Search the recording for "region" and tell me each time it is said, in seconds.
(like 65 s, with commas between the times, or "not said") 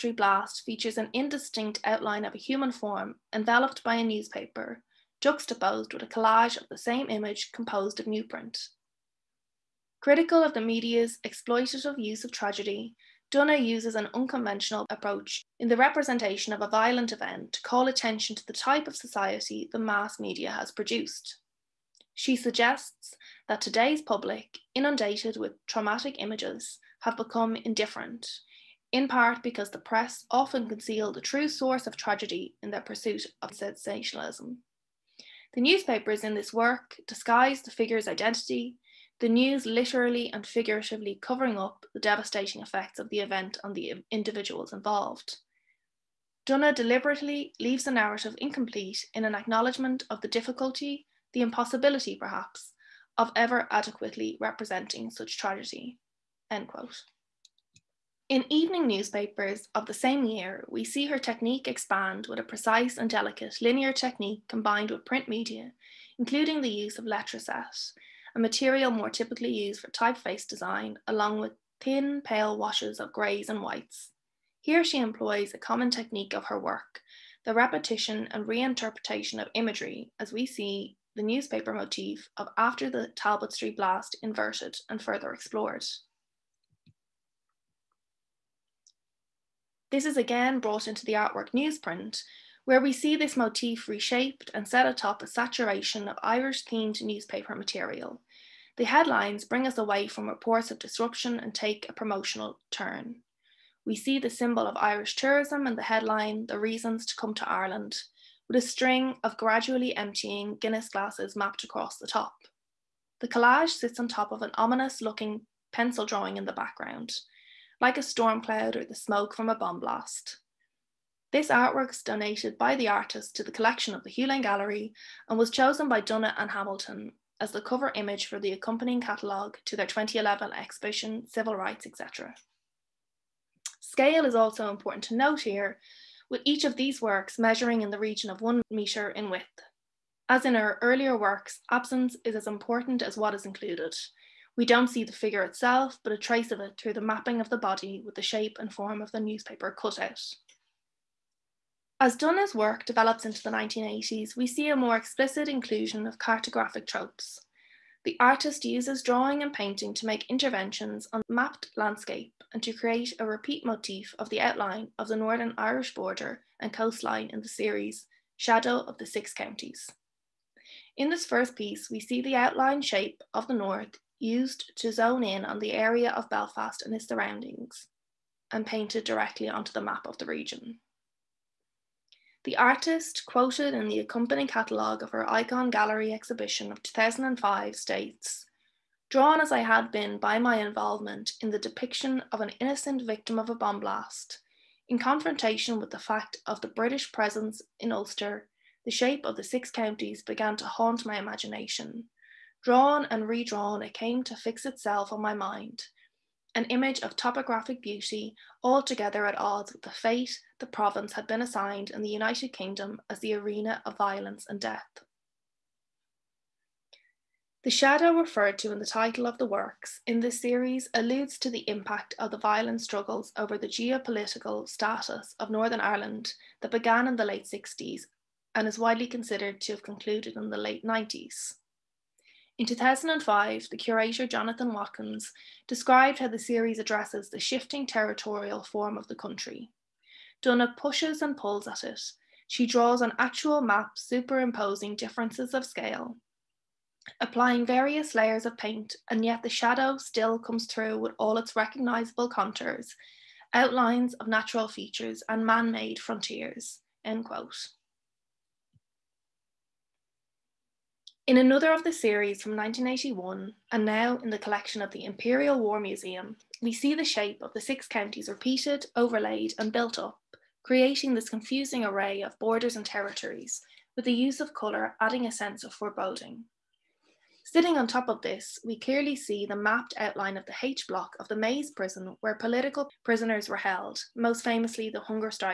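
137 s, 180 s.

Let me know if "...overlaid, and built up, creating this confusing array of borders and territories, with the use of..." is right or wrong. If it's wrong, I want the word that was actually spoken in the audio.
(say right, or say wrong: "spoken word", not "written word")
right.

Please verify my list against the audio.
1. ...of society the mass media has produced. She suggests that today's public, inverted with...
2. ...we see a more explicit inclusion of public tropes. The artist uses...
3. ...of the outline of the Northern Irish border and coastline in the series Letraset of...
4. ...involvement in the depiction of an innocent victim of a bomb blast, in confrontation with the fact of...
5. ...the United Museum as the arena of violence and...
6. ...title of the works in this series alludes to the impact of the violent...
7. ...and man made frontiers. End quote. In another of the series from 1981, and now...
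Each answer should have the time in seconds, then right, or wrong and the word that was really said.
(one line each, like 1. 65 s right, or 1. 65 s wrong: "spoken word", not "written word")
1. 18 s wrong: "inundated", not "inverted"
2. 154 s wrong: "cartographic", not "public"
3. 164 s wrong: "Shadow", not "Letraset"
4. 190 s right
5. 212 s wrong: "Kingdom", not "Museum"
6. 218 s right
7. 255 s right.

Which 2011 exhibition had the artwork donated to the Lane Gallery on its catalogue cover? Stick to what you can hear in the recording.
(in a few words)
Civil Rights, etc.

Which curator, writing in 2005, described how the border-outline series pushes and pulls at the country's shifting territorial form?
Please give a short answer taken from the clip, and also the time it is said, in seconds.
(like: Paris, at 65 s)
Jonathan Watkins, at 234 s.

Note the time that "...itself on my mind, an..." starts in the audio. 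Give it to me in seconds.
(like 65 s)
204 s.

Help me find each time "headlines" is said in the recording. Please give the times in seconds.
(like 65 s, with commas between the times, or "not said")
98 s, 105 s.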